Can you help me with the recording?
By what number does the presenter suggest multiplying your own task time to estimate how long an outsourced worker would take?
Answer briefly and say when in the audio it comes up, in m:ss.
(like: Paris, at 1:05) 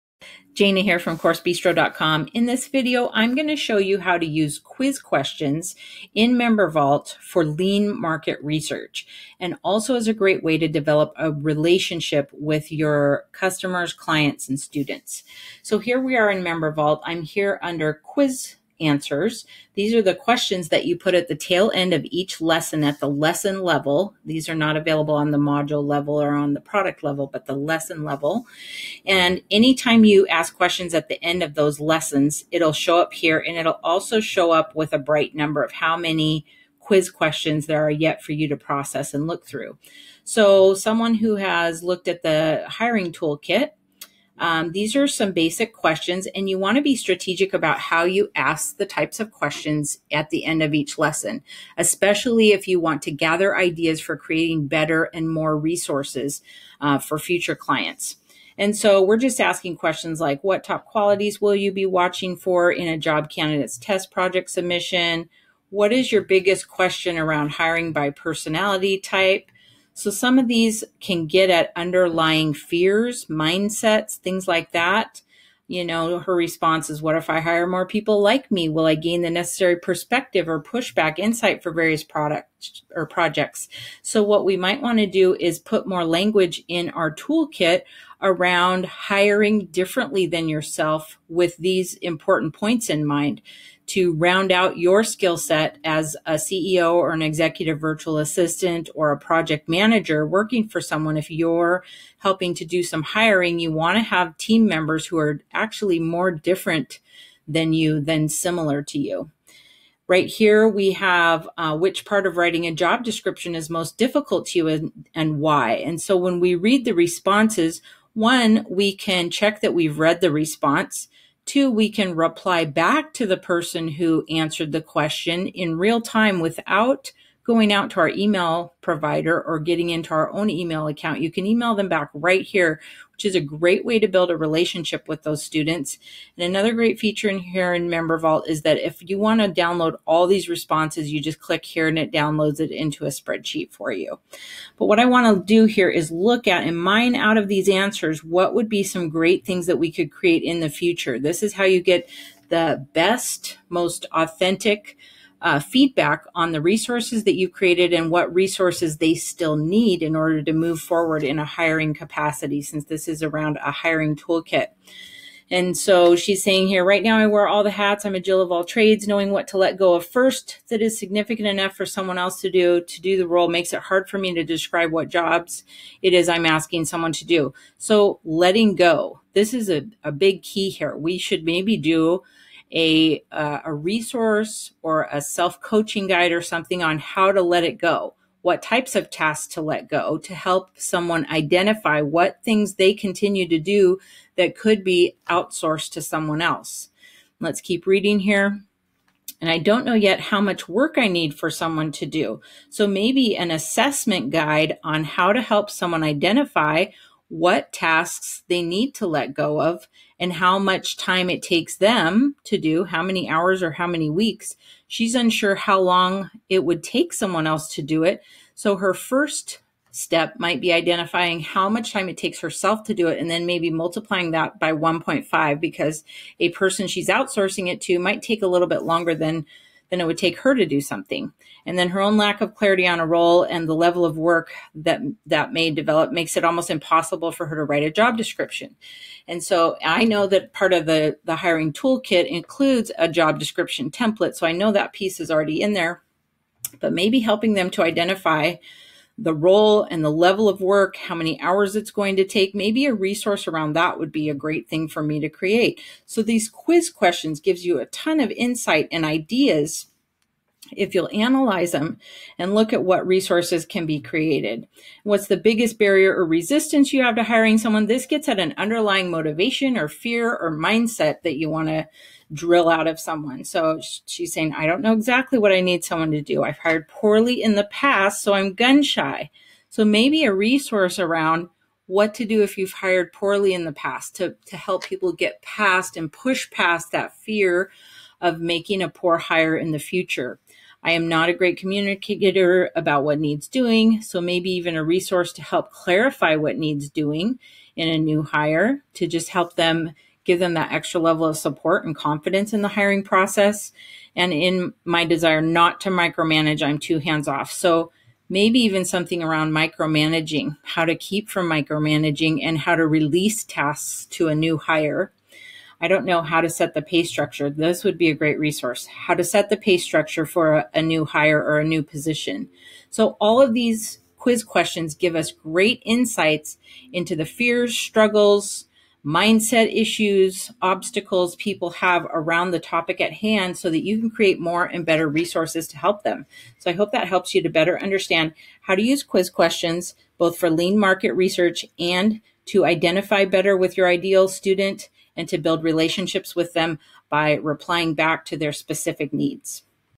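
1.5, at 3:44.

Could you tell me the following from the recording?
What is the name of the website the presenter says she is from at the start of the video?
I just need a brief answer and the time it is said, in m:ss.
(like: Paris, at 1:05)
CourseBistro.com, at 0:01.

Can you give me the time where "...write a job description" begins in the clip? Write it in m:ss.
3:57.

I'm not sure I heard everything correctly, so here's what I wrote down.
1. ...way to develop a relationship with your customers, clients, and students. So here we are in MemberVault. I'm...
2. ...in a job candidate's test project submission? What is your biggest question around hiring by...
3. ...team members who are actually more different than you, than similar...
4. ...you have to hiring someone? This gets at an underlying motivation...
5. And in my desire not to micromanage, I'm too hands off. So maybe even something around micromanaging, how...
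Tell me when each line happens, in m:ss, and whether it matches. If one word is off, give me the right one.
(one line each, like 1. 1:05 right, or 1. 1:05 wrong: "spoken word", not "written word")
1. 0:10 right
2. 1:02 right
3. 1:44 right
4. 4:26 right
5. 5:04 right.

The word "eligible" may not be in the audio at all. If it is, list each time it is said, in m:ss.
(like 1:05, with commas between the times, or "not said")
not said.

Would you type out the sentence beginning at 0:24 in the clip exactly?
These are not available on the module level or on the product level, but the lesson level.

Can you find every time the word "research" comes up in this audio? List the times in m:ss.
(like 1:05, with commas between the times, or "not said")
0:08, 5:41.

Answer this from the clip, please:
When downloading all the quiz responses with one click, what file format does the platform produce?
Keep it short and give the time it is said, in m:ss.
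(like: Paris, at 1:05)
spreadsheet, at 2:23.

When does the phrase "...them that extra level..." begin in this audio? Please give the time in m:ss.
5:00.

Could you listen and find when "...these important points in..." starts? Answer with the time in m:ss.
1:31.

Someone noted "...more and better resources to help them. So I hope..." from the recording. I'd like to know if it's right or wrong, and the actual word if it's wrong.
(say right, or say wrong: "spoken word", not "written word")
right.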